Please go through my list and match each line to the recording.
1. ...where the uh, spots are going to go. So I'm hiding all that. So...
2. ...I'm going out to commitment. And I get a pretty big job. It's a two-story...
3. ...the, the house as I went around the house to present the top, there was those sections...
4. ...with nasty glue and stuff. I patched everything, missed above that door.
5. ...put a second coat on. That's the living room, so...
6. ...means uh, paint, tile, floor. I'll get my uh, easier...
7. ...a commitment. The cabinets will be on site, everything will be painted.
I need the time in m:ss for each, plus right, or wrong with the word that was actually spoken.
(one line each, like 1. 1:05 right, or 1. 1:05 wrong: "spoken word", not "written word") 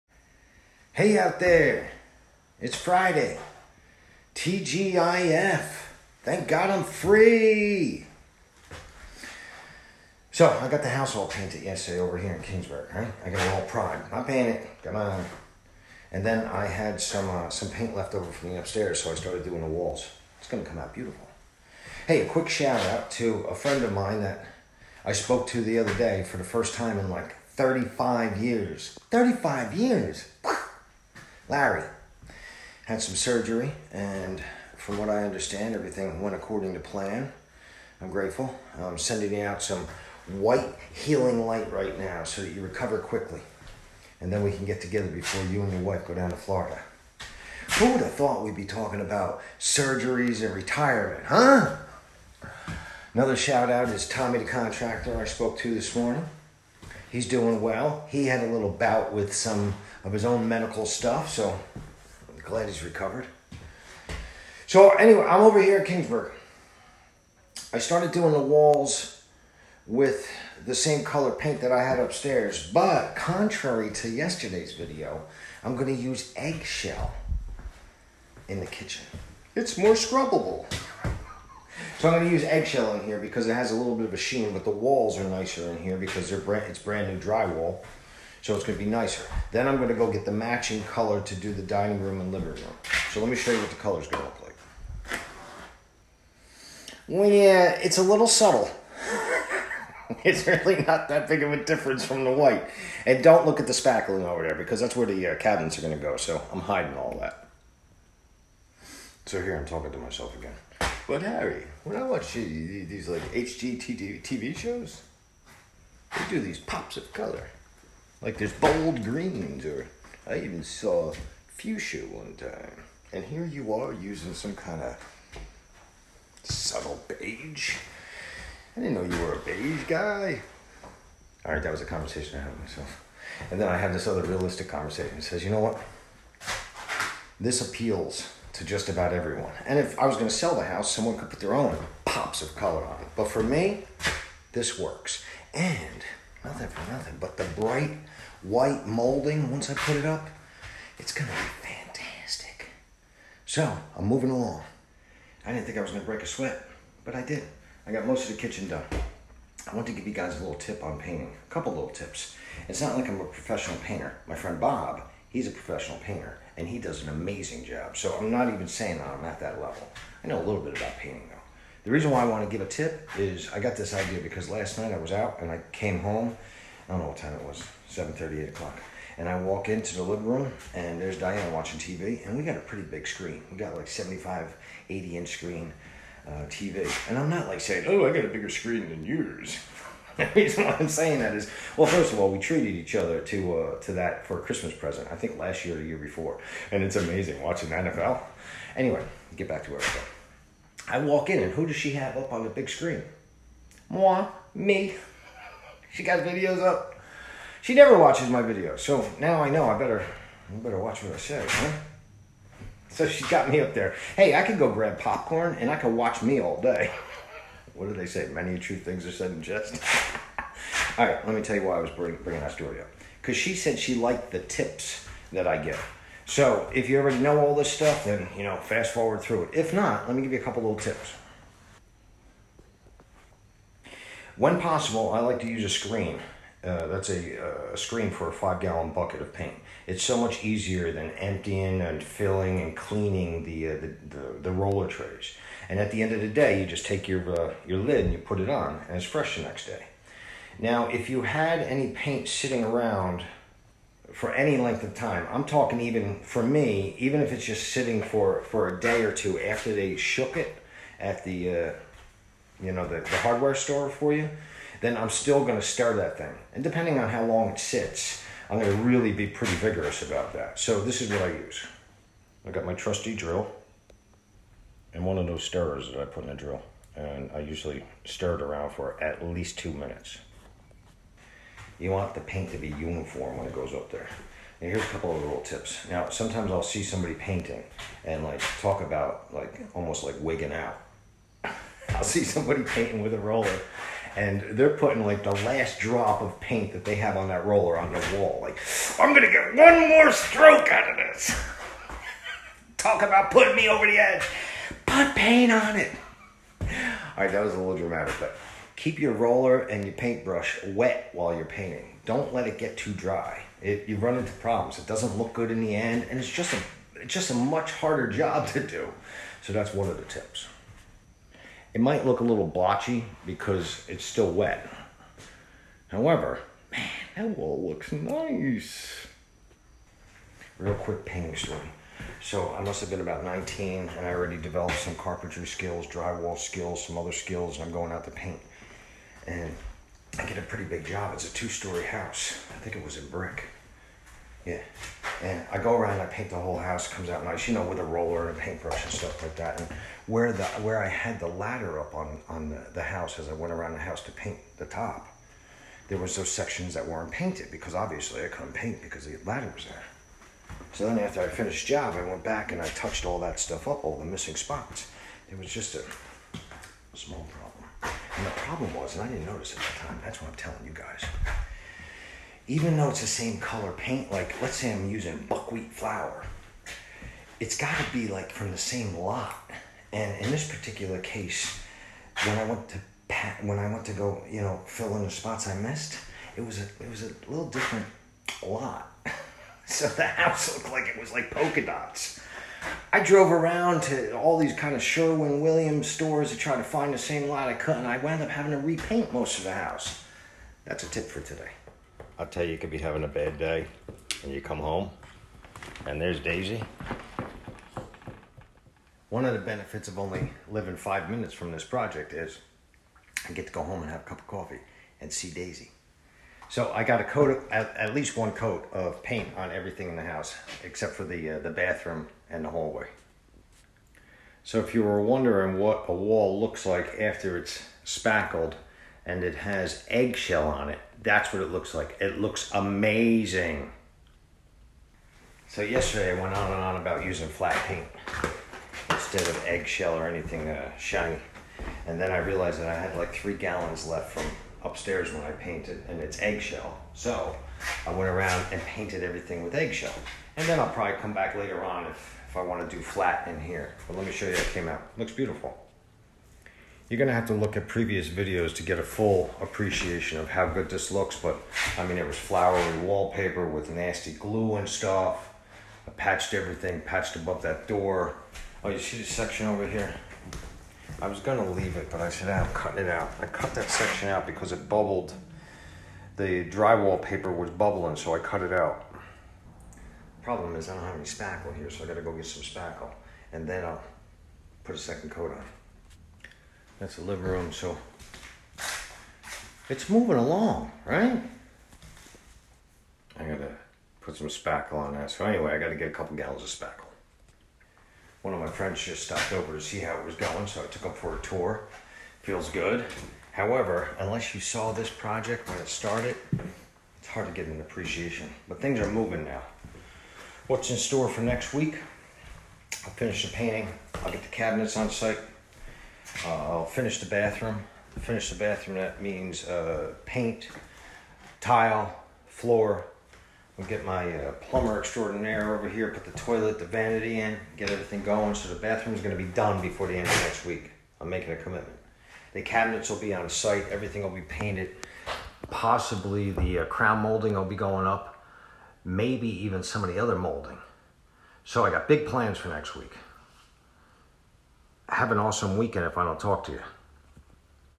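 1. 1:44 wrong: "cabinets", not "spots"
2. 5:37 wrong: "paint", not "commitment"
3. 5:52 wrong: "paint", not "present"
4. 7:43 wrong: "patched", not "missed"
5. 8:04 right
6. 8:39 wrong: "plumber", not "easier"
7. 8:51 right.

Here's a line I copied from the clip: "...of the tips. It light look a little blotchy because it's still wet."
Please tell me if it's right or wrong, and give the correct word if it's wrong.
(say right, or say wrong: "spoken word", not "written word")
wrong: "might", not "light".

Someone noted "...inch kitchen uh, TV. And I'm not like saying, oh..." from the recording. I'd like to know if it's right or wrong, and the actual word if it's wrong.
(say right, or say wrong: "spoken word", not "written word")
wrong: "screen", not "kitchen".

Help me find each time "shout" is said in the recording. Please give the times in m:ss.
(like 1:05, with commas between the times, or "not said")
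0:22, 0:53.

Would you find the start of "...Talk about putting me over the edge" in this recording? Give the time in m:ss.
5:02.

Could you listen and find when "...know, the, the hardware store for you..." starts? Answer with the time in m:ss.
4:22.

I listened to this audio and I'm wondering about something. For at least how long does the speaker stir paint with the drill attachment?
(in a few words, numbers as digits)
2 minutes.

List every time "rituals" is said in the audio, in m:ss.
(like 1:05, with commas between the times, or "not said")
not said.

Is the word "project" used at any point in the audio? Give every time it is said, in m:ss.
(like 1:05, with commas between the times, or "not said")
6:51, 8:24.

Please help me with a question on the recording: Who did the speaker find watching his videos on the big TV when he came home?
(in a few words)
Diana.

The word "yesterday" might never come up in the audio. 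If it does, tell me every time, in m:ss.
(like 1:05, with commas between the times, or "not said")
0:11, 1:14, 7:15.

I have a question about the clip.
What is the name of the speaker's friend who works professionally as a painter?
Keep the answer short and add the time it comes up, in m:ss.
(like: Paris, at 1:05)
Bob, at 2:44.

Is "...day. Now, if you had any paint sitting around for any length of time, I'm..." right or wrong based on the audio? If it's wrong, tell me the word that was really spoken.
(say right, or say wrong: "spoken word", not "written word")
right.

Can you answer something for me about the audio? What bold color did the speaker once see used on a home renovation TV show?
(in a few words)
Fuchsia.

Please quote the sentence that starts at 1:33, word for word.
So let me show you what the color's going to look like.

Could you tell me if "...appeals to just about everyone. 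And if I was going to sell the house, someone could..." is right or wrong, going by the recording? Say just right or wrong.
right.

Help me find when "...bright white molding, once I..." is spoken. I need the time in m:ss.
2:27.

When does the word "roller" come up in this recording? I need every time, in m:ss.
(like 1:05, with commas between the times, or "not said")
4:04, 4:53, 4:57, 5:09, 5:47.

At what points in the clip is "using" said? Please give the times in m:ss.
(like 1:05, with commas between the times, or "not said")
2:03, 6:14, 7:17.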